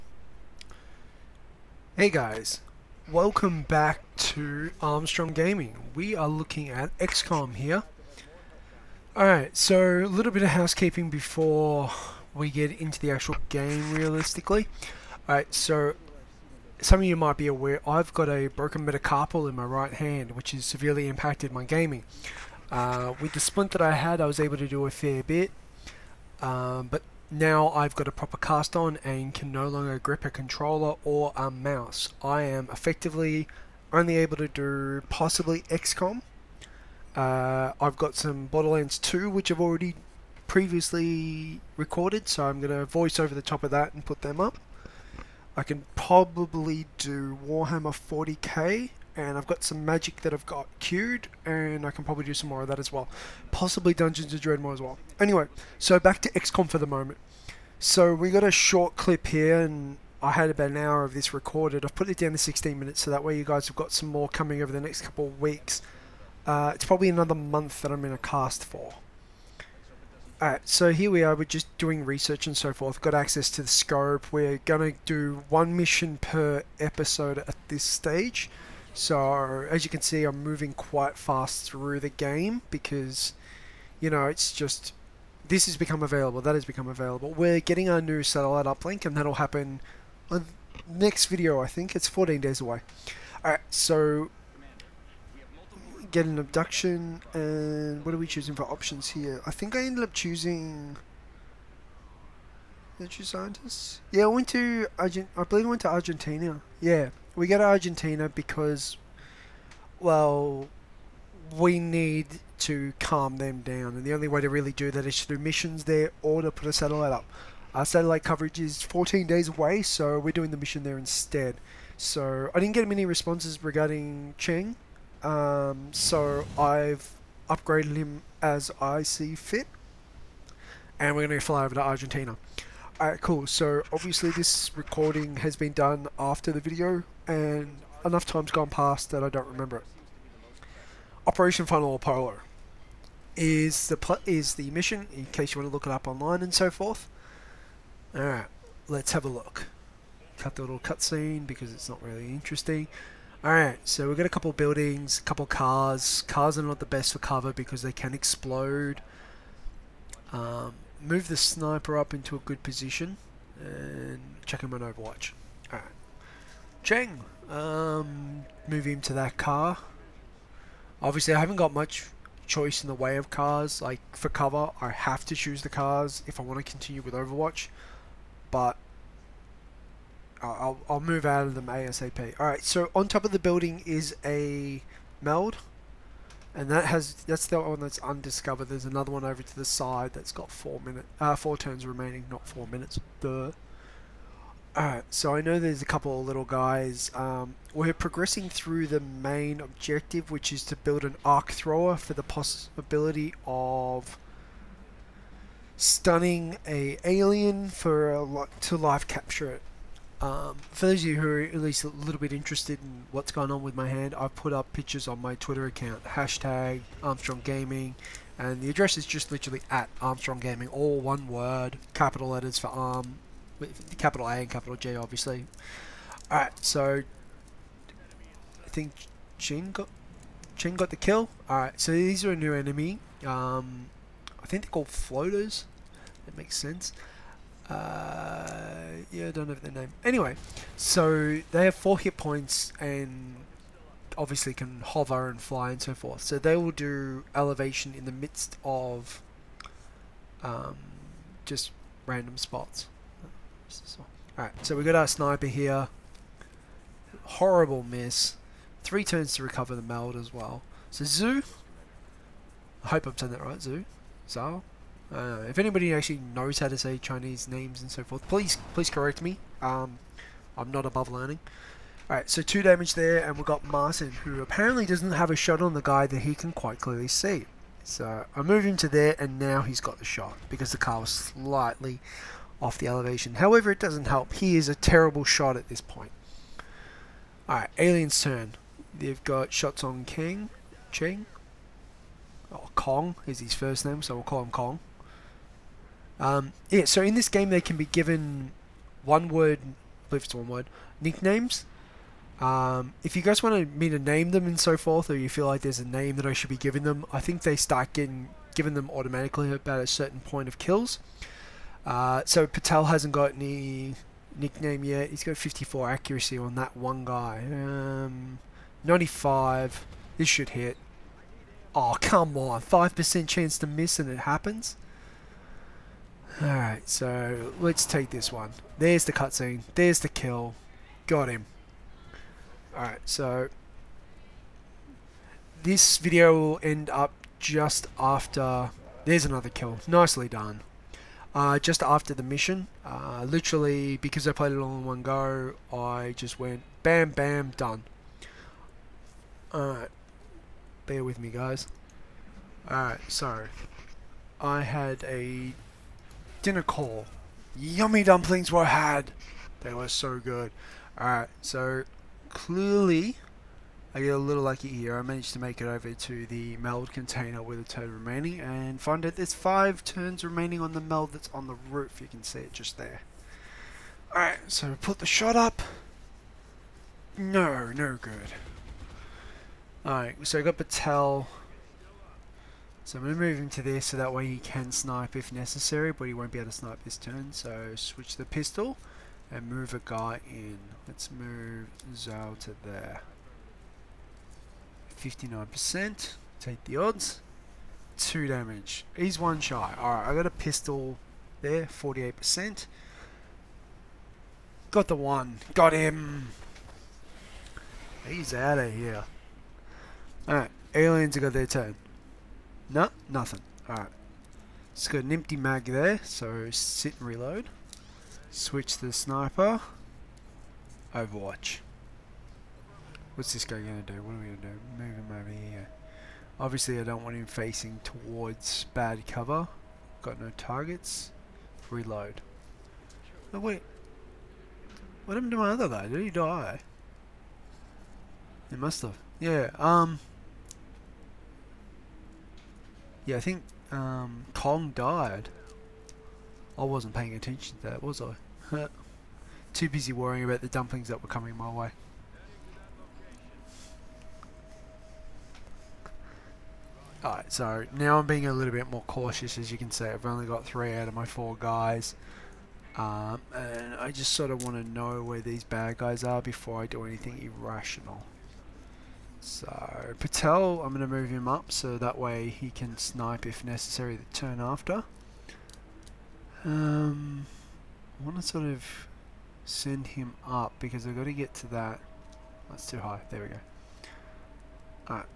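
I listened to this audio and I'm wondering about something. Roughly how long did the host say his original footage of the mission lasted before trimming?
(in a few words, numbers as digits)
about an hour.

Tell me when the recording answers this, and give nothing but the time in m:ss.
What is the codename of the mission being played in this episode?
2:21.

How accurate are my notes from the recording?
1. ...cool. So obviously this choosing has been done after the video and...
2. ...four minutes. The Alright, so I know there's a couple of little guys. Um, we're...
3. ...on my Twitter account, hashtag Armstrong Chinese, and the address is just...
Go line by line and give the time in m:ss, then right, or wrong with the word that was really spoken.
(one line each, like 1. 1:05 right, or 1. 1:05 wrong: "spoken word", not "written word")
1. 2:13 wrong: "recording", not "choosing"
2. 3:12 right
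3. 3:35 wrong: "Gaming", not "Chinese".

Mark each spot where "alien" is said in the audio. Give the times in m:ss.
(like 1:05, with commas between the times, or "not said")
3:27, 4:47, 6:50.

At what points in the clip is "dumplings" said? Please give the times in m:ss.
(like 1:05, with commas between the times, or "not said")
5:58, 7:30.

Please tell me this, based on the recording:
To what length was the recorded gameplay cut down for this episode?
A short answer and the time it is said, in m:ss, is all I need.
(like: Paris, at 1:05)
16 minutes, at 1:02.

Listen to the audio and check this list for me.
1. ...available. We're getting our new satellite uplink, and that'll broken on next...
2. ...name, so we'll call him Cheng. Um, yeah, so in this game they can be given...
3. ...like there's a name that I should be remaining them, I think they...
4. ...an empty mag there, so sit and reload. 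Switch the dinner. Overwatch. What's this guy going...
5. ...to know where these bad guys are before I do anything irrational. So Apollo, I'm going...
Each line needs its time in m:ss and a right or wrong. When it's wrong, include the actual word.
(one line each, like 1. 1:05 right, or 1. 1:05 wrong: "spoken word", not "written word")
1. 1:26 wrong: "happen", not "broken"
2. 4:53 wrong: "Kong", not "Cheng"
3. 5:05 wrong: "giving", not "remaining"
4. 6:55 wrong: "sniper", not "dinner"
5. 7:44 wrong: "Patel", not "Apollo".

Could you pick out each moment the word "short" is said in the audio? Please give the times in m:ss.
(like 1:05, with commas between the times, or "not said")
0:58.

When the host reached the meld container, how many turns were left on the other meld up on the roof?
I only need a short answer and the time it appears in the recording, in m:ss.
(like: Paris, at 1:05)
5, at 6:09.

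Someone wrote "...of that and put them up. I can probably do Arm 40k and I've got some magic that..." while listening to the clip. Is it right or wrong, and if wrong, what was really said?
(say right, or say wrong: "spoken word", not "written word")
wrong: "Warhammer", not "Arm".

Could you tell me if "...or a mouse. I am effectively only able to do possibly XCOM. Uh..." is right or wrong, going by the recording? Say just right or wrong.
right.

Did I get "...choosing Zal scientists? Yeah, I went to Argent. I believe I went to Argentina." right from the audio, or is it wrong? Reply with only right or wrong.
wrong.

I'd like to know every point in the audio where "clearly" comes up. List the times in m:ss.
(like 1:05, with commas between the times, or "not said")
4:36, 6:02.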